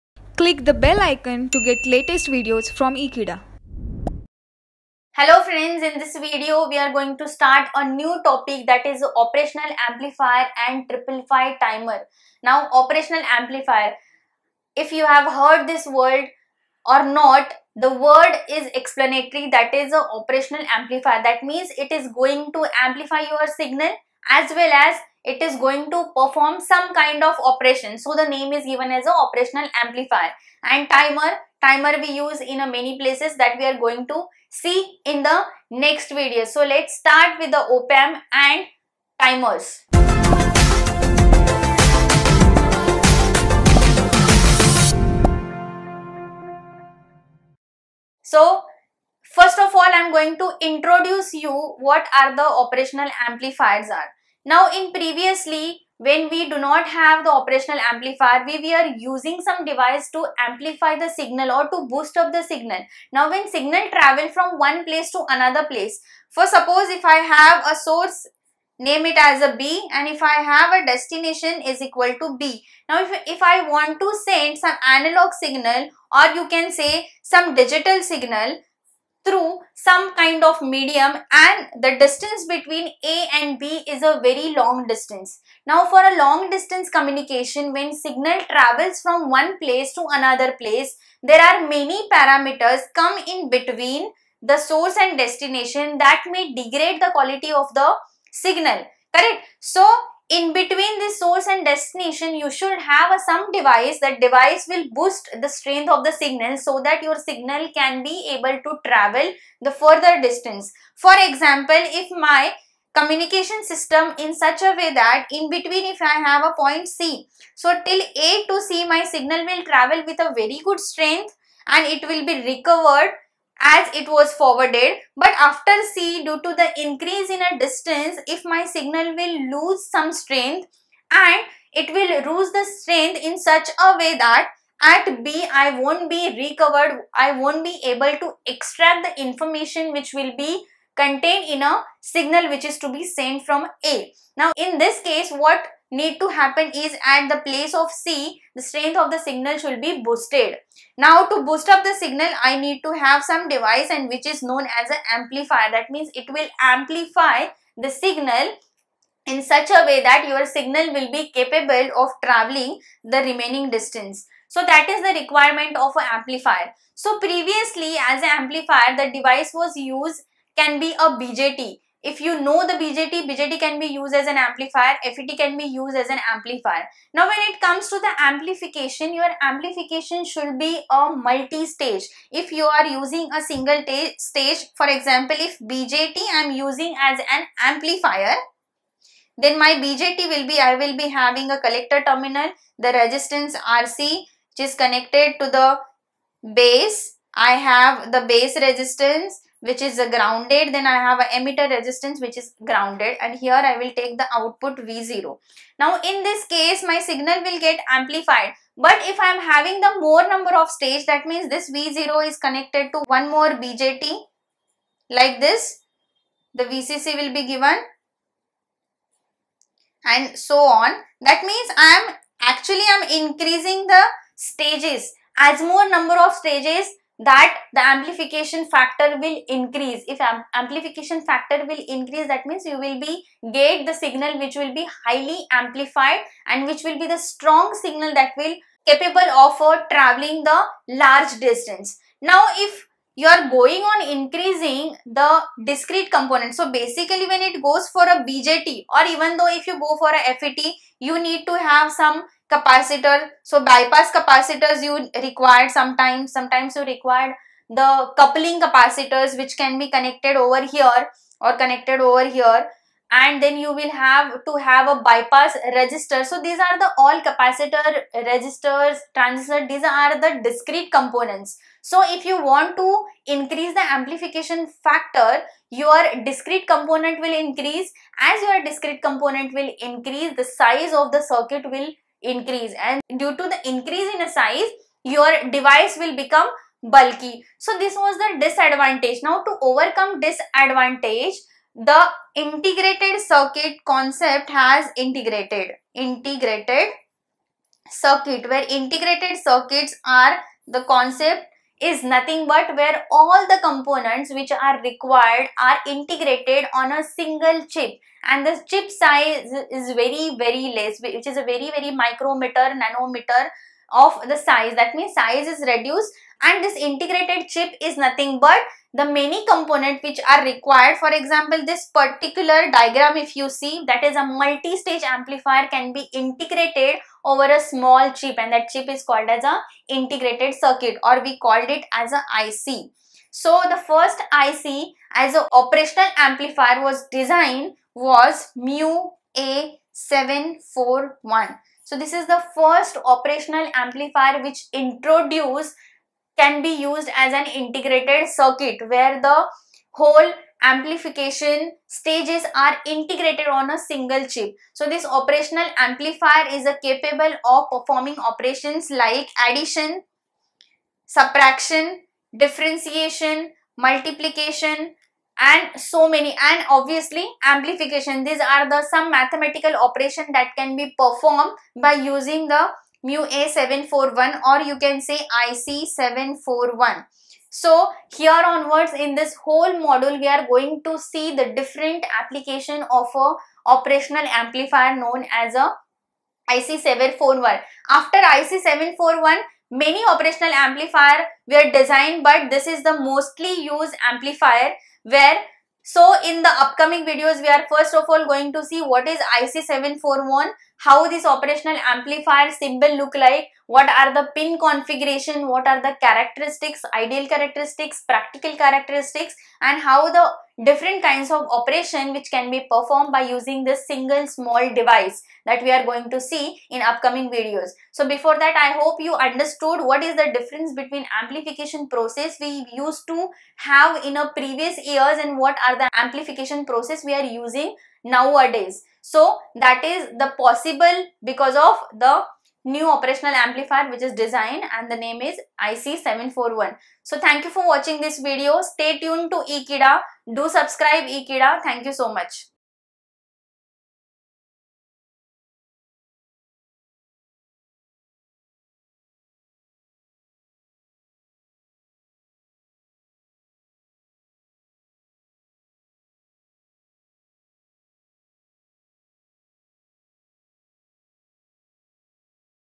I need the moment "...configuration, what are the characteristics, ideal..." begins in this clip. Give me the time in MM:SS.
06:44.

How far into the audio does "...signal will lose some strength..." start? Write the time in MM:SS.
02:08.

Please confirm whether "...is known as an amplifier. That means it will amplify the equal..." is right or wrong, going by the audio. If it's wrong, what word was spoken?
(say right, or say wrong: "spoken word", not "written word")
wrong: "signal", not "equal".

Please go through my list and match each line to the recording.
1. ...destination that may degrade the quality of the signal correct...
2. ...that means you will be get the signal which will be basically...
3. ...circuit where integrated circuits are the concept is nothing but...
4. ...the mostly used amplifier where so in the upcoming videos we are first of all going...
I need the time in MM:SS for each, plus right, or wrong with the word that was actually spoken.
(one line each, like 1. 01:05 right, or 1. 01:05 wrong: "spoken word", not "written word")
1. 01:35 right
2. 03:52 wrong: "highly", not "basically"
3. 04:57 right
4. 06:32 right.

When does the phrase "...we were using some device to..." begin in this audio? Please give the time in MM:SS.
00:58.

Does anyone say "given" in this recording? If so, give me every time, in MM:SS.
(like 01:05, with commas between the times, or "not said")
00:28, 03:37.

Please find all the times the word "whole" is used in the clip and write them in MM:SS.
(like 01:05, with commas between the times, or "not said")
05:49, 06:19.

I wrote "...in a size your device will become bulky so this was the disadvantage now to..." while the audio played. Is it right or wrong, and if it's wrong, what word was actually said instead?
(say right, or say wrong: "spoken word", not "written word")
right.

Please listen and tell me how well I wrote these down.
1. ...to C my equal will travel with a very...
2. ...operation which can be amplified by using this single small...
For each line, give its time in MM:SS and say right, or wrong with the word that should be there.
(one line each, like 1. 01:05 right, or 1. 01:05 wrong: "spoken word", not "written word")
1. 01:58 wrong: "signal", not "equal"
2. 06:51 wrong: "performed", not "amplified".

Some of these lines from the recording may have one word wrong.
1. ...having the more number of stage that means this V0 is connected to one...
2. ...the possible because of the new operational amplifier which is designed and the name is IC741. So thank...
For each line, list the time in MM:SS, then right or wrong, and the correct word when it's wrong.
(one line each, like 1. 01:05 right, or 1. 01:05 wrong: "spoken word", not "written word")
1. 03:29 right
2. 07:10 right.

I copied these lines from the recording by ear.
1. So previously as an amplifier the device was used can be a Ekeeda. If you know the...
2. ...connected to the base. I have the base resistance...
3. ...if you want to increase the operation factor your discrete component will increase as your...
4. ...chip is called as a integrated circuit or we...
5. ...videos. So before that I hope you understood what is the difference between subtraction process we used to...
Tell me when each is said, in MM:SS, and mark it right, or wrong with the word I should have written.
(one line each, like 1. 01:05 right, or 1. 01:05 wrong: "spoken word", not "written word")
1. 02:46 wrong: "BJT", not "Ekeeda"
2. 03:14 right
3. 04:32 wrong: "amplification", not "operation"
4. 05:28 right
5. 06:57 wrong: "amplification", not "subtraction".